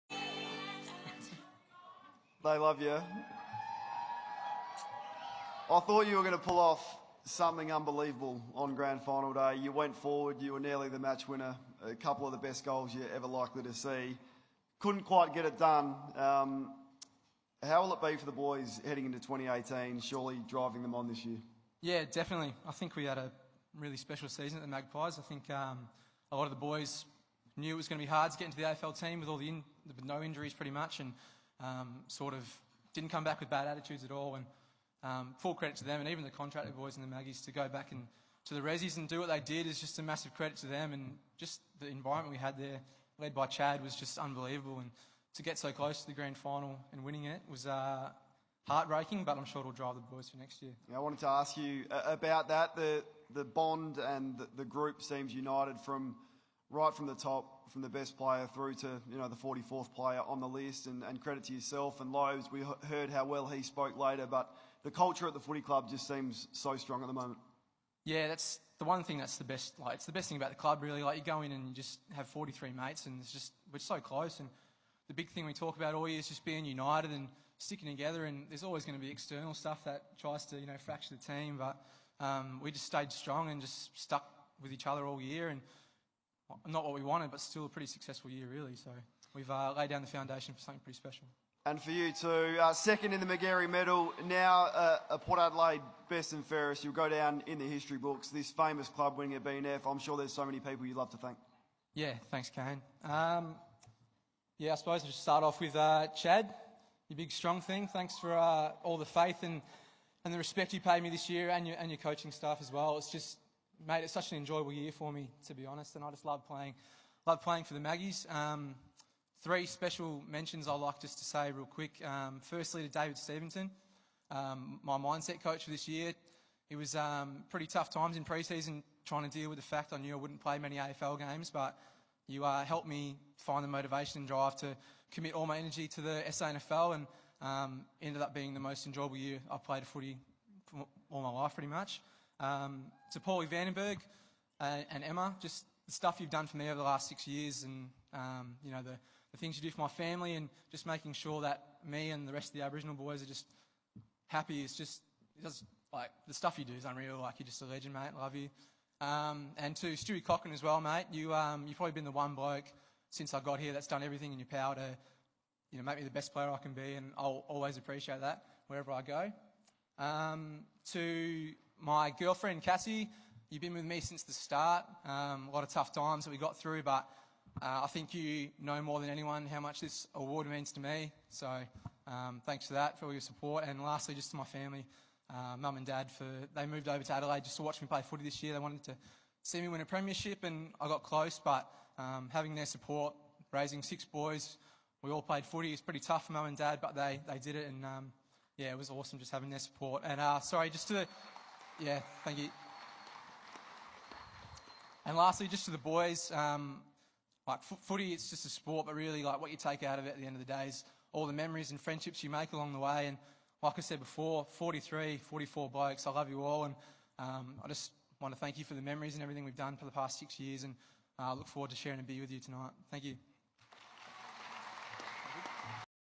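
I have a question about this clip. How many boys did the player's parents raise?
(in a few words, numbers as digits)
6.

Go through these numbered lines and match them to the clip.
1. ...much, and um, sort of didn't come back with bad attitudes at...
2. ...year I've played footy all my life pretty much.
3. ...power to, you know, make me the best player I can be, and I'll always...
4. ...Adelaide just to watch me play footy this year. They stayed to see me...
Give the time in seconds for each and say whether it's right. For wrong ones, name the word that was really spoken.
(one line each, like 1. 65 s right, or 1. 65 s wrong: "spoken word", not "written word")
1. 30 s right
2. 139 s right
3. 164 s right
4. 187 s wrong: "wanted", not "stayed".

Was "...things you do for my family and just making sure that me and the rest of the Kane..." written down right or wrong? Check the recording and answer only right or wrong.
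wrong.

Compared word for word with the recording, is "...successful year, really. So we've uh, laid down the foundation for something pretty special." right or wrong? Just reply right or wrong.
right.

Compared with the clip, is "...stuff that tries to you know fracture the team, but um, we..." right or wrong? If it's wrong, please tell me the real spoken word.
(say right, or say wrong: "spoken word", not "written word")
right.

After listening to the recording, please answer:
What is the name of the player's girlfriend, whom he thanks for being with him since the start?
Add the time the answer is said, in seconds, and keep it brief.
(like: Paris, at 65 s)
Cassie, at 172 s.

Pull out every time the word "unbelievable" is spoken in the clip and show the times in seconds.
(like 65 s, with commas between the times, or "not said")
7 s, 44 s.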